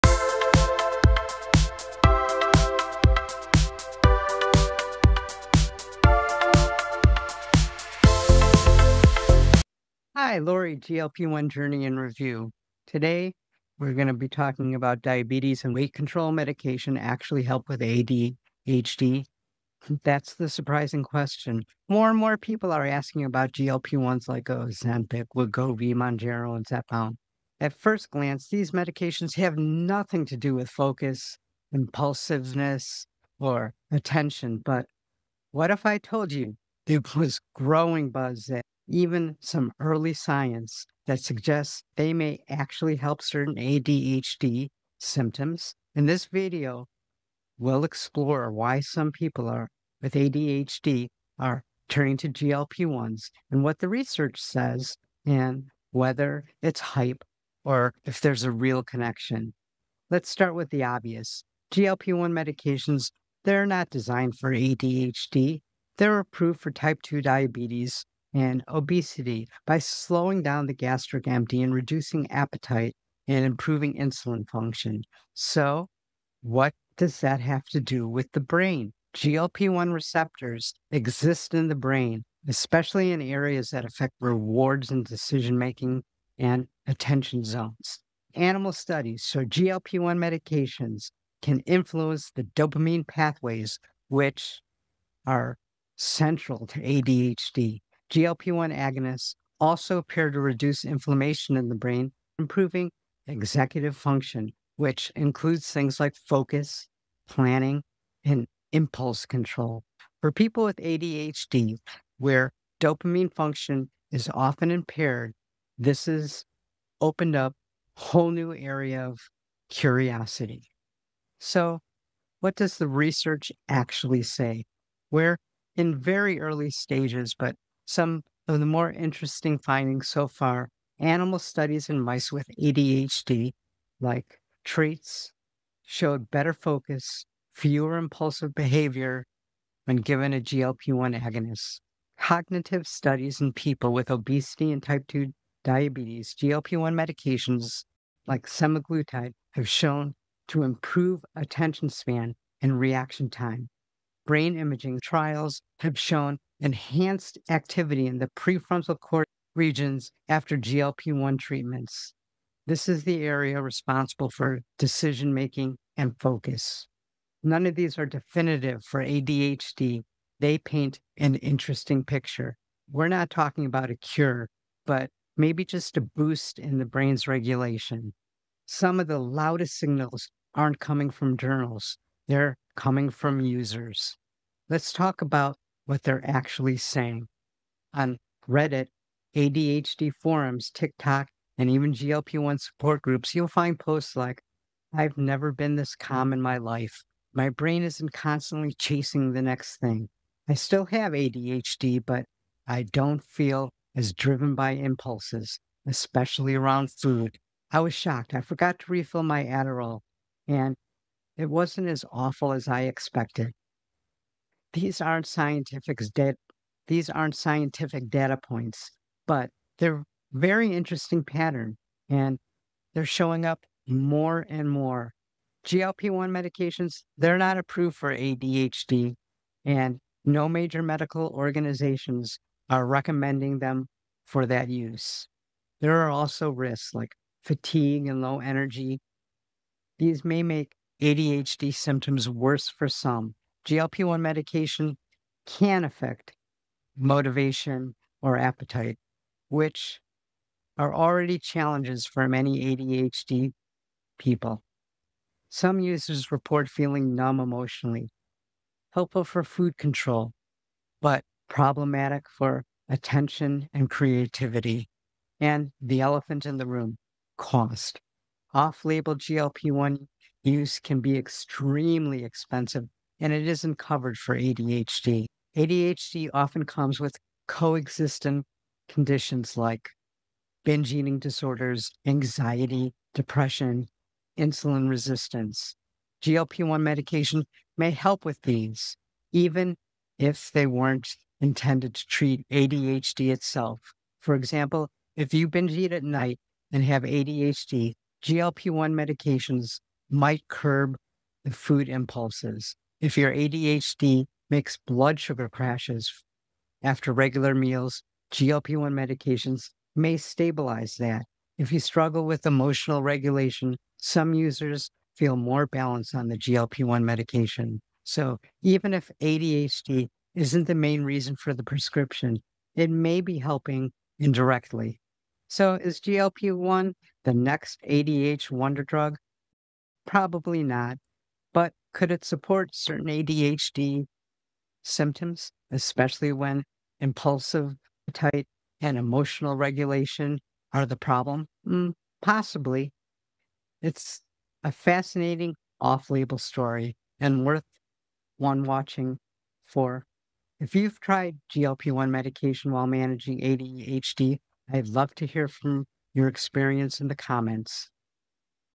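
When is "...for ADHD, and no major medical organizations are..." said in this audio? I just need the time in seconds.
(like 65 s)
227 s.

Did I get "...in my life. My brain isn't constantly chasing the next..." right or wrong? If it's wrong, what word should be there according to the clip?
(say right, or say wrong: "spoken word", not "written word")
right.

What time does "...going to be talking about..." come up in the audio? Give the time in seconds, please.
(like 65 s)
13 s.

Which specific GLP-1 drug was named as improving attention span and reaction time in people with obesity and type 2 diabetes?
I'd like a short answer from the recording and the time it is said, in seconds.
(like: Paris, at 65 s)
Semaglutide, at 148 s.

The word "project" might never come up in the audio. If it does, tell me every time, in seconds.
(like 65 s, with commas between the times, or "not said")
not said.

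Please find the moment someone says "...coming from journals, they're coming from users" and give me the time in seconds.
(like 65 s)
180 s.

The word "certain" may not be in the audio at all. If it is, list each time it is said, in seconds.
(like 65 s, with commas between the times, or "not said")
43 s, 332 s.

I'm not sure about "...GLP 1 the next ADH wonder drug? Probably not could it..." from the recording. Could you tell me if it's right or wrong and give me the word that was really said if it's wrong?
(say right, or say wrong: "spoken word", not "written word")
right.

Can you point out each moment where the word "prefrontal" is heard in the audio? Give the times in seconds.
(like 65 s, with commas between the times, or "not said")
158 s.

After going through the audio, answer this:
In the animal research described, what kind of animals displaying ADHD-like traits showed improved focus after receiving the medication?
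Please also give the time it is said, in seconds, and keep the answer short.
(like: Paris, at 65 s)
Mice, at 131 s.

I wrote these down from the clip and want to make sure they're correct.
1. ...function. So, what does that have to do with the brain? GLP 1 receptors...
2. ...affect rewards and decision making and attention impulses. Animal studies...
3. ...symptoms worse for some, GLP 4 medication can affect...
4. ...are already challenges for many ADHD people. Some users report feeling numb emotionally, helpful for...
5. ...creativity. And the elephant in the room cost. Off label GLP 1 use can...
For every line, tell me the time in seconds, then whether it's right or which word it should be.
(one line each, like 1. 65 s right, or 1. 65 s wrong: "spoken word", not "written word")
1. 74 s right
2. 83 s wrong: "zones", not "impulses"
3. 241 s wrong: "1", not "4"
4. 250 s right
5. 263 s right.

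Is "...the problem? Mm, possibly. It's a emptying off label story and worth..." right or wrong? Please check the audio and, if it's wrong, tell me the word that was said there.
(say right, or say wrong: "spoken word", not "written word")
wrong: "fascinating", not "emptying".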